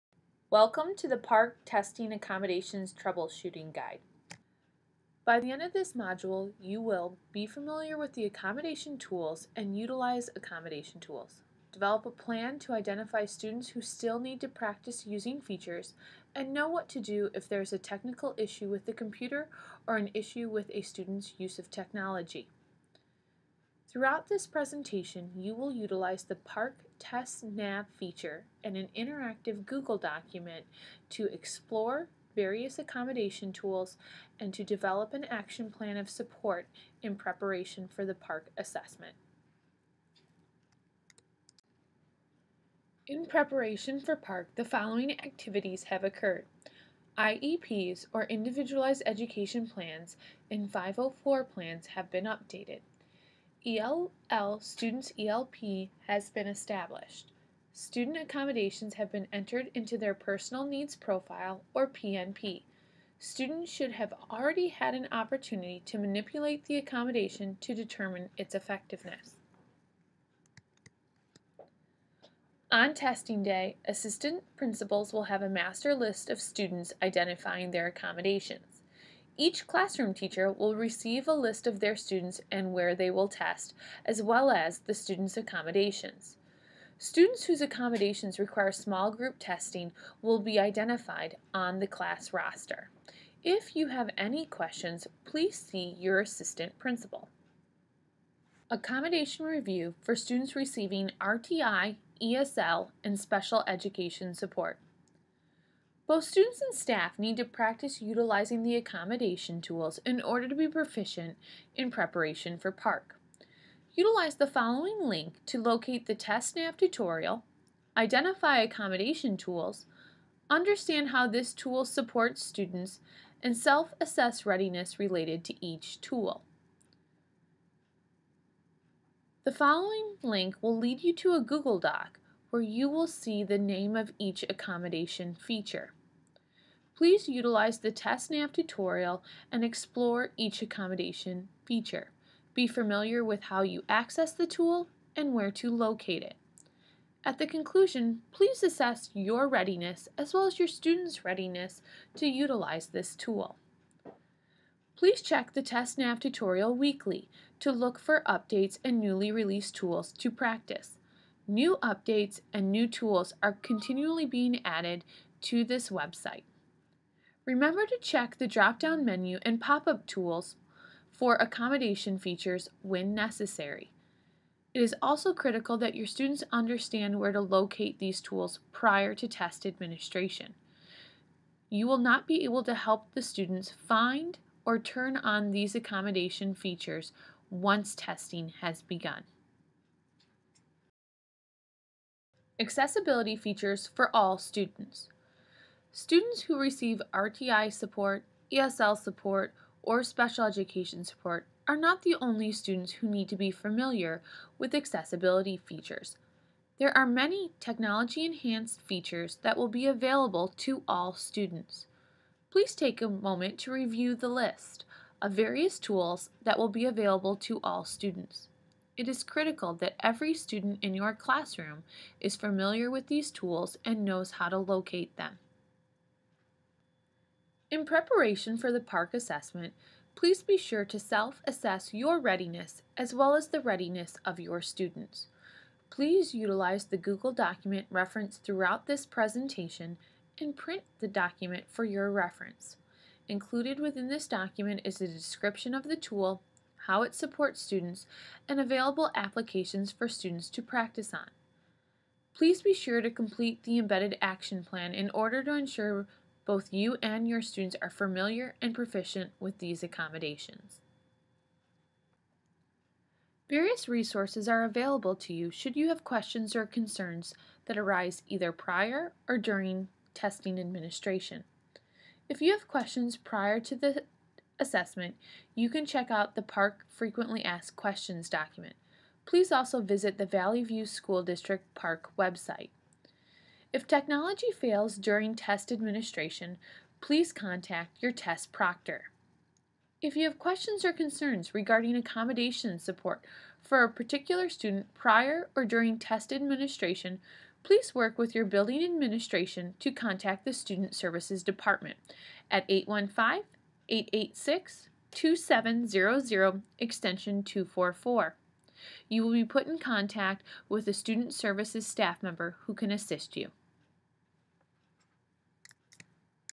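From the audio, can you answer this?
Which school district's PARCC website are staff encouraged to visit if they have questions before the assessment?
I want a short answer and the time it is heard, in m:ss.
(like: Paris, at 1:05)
Valley View School District, at 4:40.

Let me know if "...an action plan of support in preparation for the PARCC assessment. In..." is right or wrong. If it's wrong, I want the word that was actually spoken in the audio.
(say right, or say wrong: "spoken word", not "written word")
right.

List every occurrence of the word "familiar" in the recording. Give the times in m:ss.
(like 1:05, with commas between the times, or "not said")
0:07, 2:22, 3:23, 3:42, 4:17.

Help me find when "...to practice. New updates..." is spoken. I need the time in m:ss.
2:40.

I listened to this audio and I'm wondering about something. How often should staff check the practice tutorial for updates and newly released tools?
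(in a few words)
weekly.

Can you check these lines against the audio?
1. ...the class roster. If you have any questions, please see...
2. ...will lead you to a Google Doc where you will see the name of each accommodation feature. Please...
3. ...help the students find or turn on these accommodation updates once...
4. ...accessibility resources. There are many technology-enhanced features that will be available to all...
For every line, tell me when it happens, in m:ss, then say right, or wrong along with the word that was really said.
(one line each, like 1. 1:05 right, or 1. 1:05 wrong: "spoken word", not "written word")
1. 1:31 right
2. 2:10 right
3. 3:02 wrong: "features", not "updates"
4. 3:24 wrong: "features", not "resources".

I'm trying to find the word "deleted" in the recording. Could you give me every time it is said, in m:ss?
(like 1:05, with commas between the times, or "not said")
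not said.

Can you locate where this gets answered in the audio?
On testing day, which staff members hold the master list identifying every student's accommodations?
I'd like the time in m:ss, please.
1:13.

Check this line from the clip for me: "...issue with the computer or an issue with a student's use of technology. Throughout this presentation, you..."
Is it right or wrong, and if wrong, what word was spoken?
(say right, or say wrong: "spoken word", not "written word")
right.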